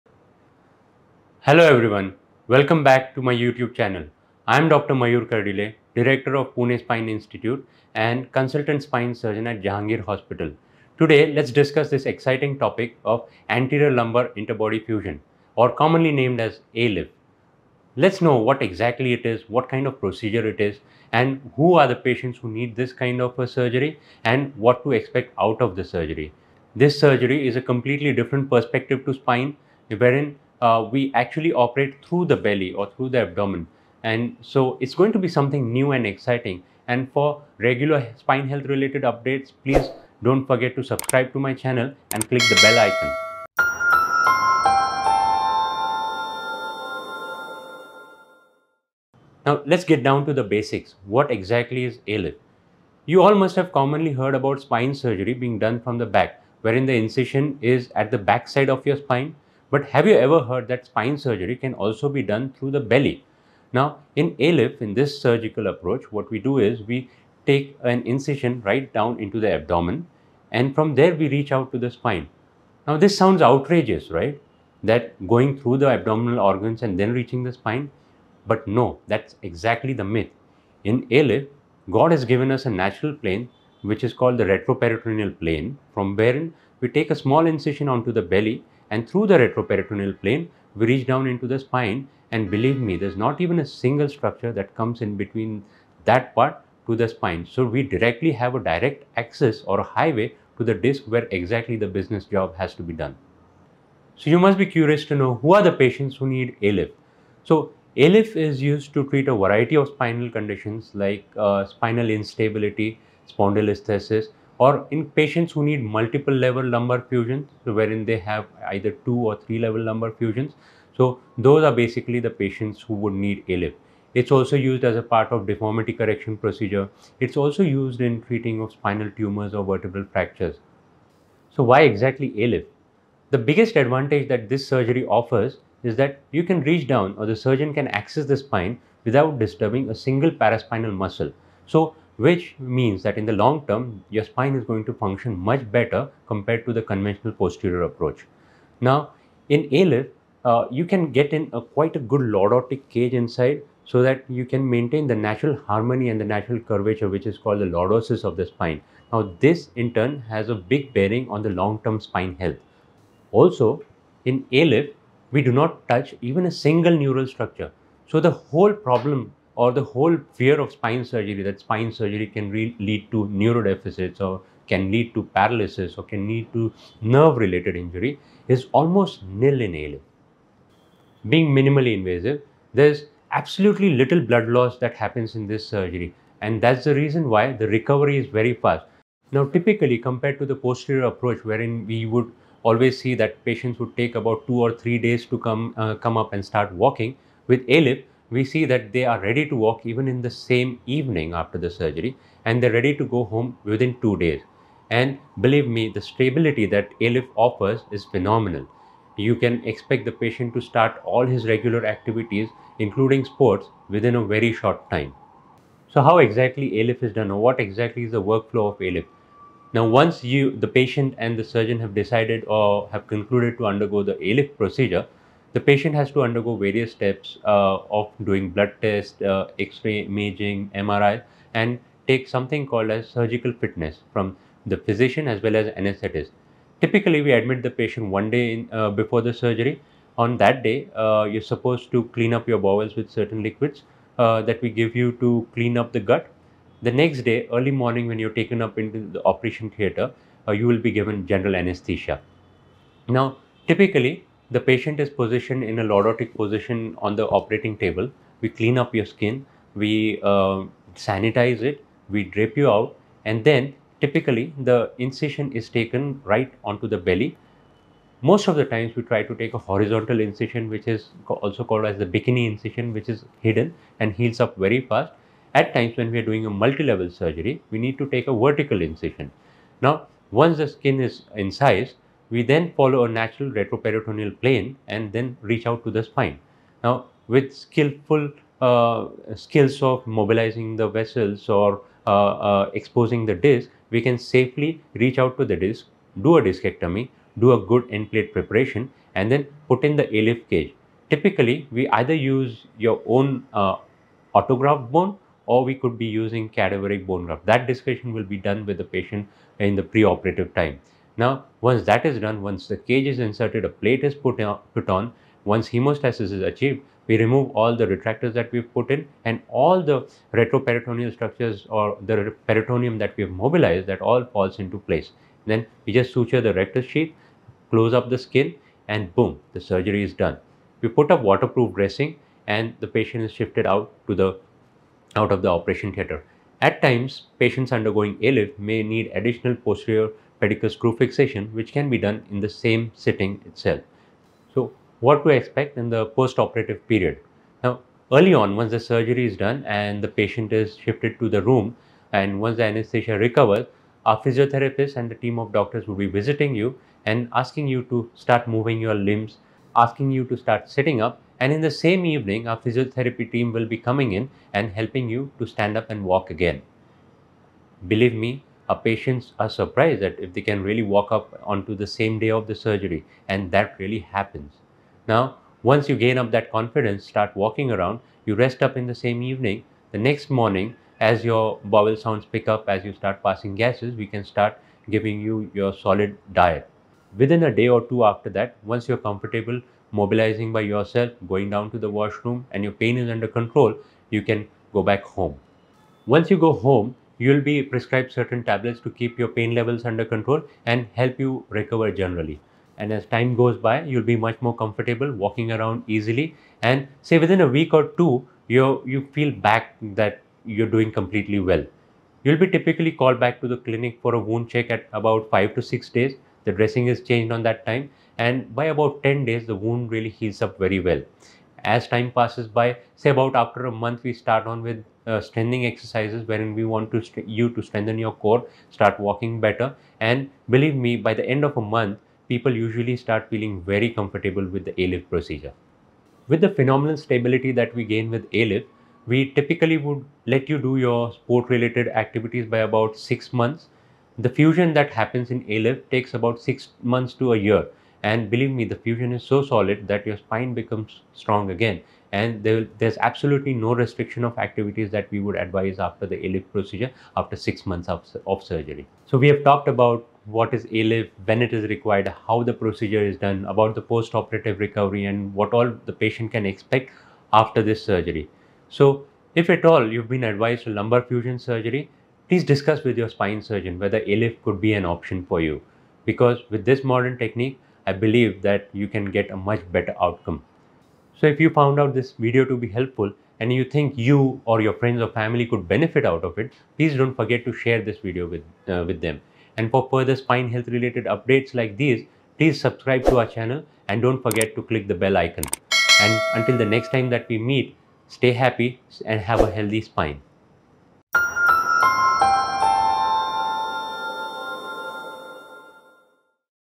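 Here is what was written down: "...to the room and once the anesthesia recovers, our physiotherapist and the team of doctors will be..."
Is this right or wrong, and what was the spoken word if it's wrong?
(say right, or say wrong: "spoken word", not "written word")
right.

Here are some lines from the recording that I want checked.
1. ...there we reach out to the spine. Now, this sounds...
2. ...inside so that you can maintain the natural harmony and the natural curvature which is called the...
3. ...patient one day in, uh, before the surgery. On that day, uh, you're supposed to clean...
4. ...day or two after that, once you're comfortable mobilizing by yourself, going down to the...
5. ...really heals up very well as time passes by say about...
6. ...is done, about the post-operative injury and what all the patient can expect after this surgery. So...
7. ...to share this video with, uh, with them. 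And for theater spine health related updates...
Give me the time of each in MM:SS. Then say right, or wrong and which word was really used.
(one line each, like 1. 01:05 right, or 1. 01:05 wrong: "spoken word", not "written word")
1. 01:10 right
2. 02:33 right
3. 03:57 right
4. 06:27 right
5. 06:59 right
6. 07:43 wrong: "recovery", not "injury"
7. 08:07 wrong: "further", not "theater".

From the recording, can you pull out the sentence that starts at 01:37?
So we directly have a direct access or a highway to the disc where exactly the business job has to be done.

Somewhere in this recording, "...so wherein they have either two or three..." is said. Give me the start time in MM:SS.
01:57.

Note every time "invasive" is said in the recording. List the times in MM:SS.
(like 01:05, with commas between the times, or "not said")
03:01.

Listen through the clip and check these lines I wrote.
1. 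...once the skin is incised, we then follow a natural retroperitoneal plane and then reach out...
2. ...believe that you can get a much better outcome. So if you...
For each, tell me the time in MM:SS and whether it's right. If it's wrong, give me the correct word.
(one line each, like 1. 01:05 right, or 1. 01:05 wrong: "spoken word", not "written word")
1. 04:40 right
2. 07:58 right.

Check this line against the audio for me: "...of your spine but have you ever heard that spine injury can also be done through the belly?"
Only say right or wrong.
wrong.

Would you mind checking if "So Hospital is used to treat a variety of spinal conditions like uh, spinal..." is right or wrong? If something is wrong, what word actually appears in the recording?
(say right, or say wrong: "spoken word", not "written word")
wrong: "ALIF", not "Hospital".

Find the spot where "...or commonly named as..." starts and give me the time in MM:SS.
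00:15.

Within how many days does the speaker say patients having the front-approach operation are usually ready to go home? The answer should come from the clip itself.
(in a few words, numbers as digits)
2 days.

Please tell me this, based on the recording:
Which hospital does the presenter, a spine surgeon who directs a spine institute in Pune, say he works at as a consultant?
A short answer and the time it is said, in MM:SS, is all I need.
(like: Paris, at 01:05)
Jahangir Hospital, at 00:09.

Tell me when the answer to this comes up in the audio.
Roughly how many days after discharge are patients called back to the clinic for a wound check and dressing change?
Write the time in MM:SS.
06:55.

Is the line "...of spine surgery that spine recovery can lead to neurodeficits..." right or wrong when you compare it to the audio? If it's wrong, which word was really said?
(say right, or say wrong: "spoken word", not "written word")
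wrong: "surgery", not "recovery".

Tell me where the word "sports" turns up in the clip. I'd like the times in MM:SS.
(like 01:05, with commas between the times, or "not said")
03:33, 07:21.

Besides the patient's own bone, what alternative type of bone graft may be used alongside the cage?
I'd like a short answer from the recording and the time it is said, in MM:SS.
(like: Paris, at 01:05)
cadaveric bone graft, at 05:06.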